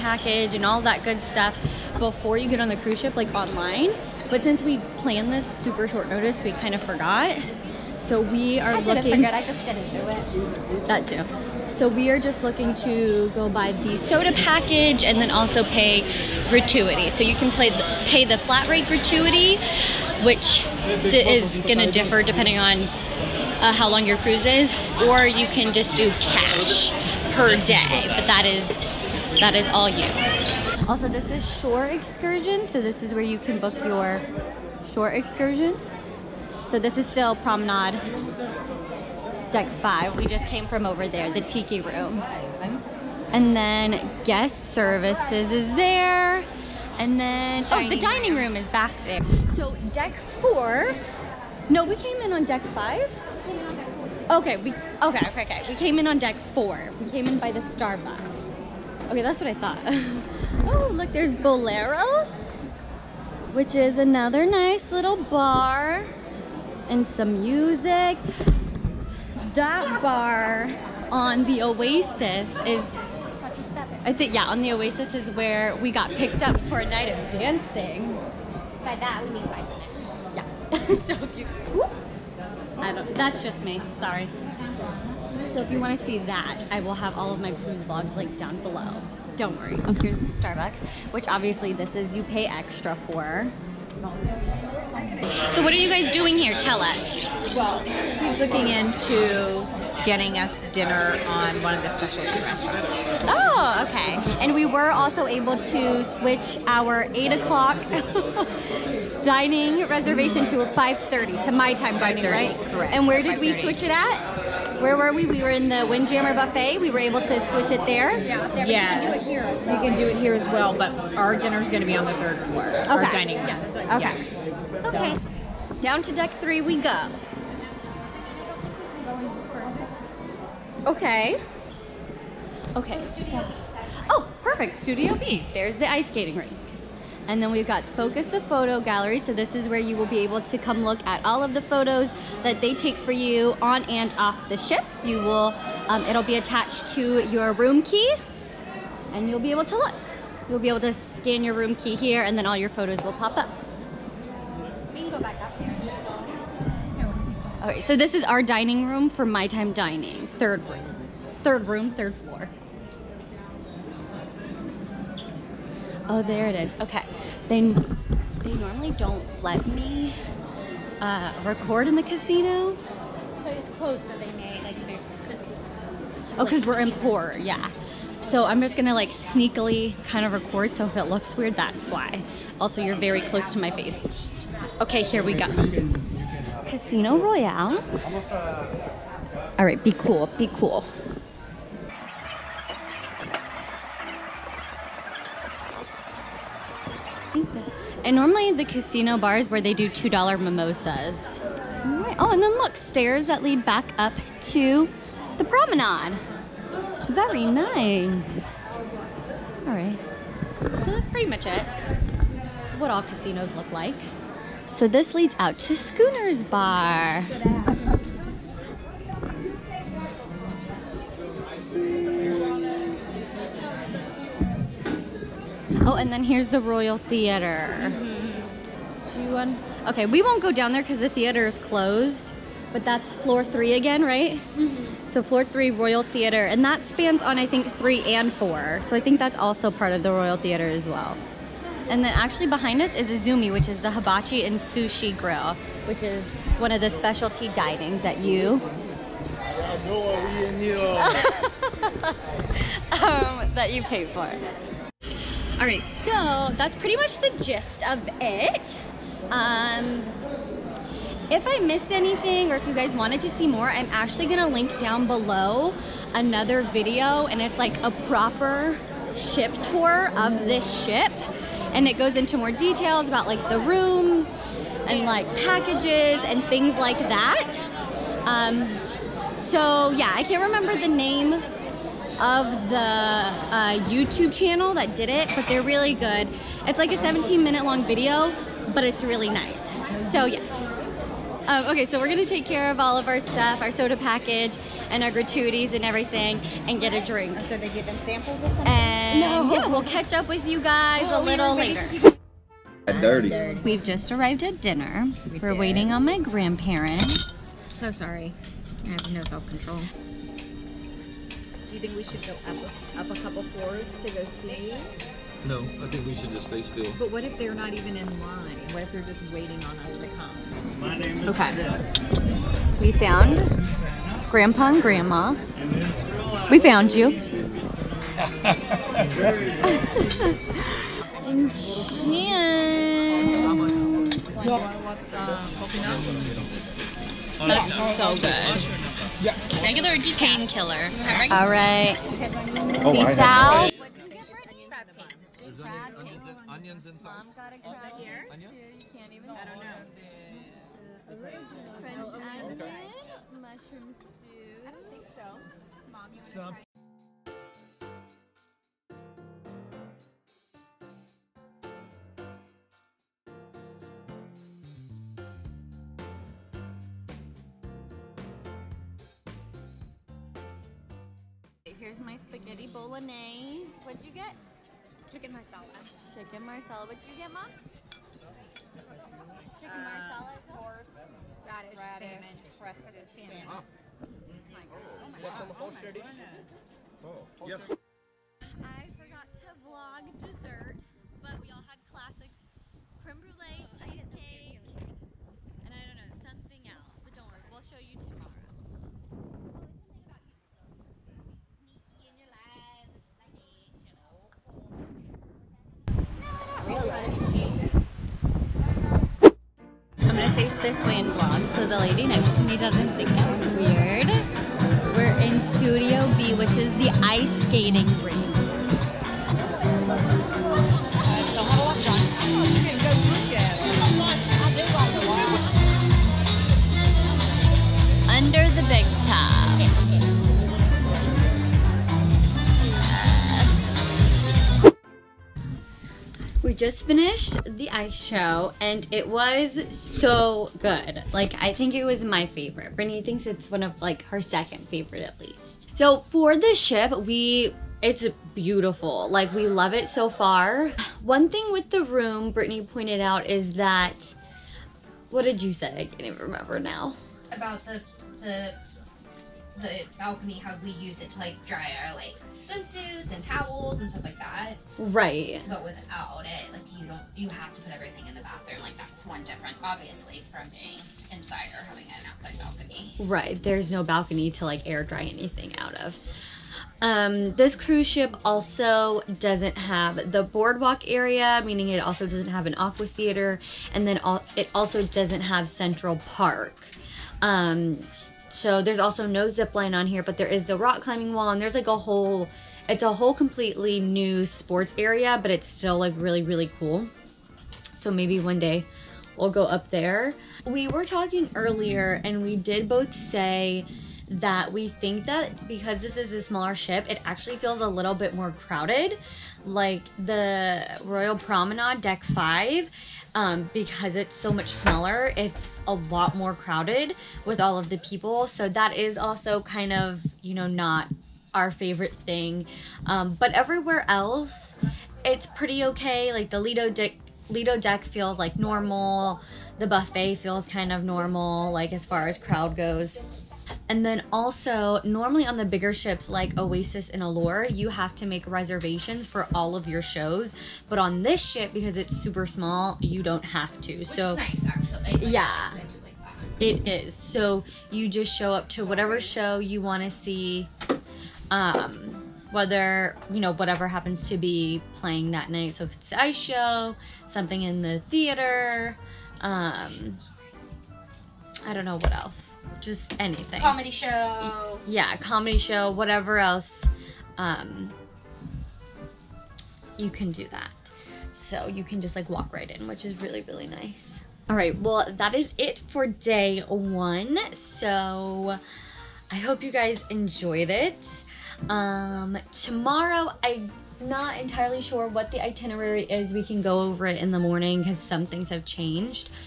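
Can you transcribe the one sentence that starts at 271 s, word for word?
And it goes into more details about like the rooms and like packages and things like that.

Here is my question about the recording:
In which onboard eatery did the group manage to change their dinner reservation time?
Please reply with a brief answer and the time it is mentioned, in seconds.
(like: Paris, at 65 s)
Windjammer Buffet, at 115 s.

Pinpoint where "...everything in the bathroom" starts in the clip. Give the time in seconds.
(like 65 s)
467 s.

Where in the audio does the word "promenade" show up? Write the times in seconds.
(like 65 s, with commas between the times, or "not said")
37 s, 205 s, 511 s.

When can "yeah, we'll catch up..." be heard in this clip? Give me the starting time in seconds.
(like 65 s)
299 s.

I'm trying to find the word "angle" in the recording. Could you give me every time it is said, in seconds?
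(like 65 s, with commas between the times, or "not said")
not said.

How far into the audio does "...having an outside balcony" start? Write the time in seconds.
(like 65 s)
471 s.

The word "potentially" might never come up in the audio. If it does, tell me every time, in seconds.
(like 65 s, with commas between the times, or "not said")
not said.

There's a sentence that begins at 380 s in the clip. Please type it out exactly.
That is radish, salmon, crested salmon.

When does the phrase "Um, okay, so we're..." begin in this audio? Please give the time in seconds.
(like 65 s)
291 s.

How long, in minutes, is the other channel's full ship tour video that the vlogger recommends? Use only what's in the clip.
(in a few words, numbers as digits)
17 minutes.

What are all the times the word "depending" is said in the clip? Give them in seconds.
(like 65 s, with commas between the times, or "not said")
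22 s.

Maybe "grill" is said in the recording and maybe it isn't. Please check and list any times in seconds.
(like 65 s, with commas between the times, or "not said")
245 s.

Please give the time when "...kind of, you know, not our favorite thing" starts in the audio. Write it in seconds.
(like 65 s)
519 s.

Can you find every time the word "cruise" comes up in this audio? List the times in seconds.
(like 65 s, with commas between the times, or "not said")
2 s, 24 s, 87 s, 477 s.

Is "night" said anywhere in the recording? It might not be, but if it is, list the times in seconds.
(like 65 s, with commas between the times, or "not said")
76 s, 555 s.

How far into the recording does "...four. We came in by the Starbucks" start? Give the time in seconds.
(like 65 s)
56 s.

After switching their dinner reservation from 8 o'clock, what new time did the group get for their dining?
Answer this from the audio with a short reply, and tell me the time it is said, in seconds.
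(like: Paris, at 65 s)
5:30, at 110 s.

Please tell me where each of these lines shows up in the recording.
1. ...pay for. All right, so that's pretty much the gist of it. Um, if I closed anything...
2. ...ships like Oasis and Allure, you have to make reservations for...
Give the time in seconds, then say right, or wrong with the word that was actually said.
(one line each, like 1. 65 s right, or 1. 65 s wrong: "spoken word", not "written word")
1. 253 s wrong: "missed", not "closed"
2. 535 s right.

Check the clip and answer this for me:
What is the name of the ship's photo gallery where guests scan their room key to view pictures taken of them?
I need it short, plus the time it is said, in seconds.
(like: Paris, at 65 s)
Focus, at 137 s.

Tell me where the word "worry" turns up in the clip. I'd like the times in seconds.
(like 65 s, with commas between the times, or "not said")
89 s, 397 s.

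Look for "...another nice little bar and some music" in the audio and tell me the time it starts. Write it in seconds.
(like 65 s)
63 s.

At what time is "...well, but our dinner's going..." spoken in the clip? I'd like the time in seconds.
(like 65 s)
120 s.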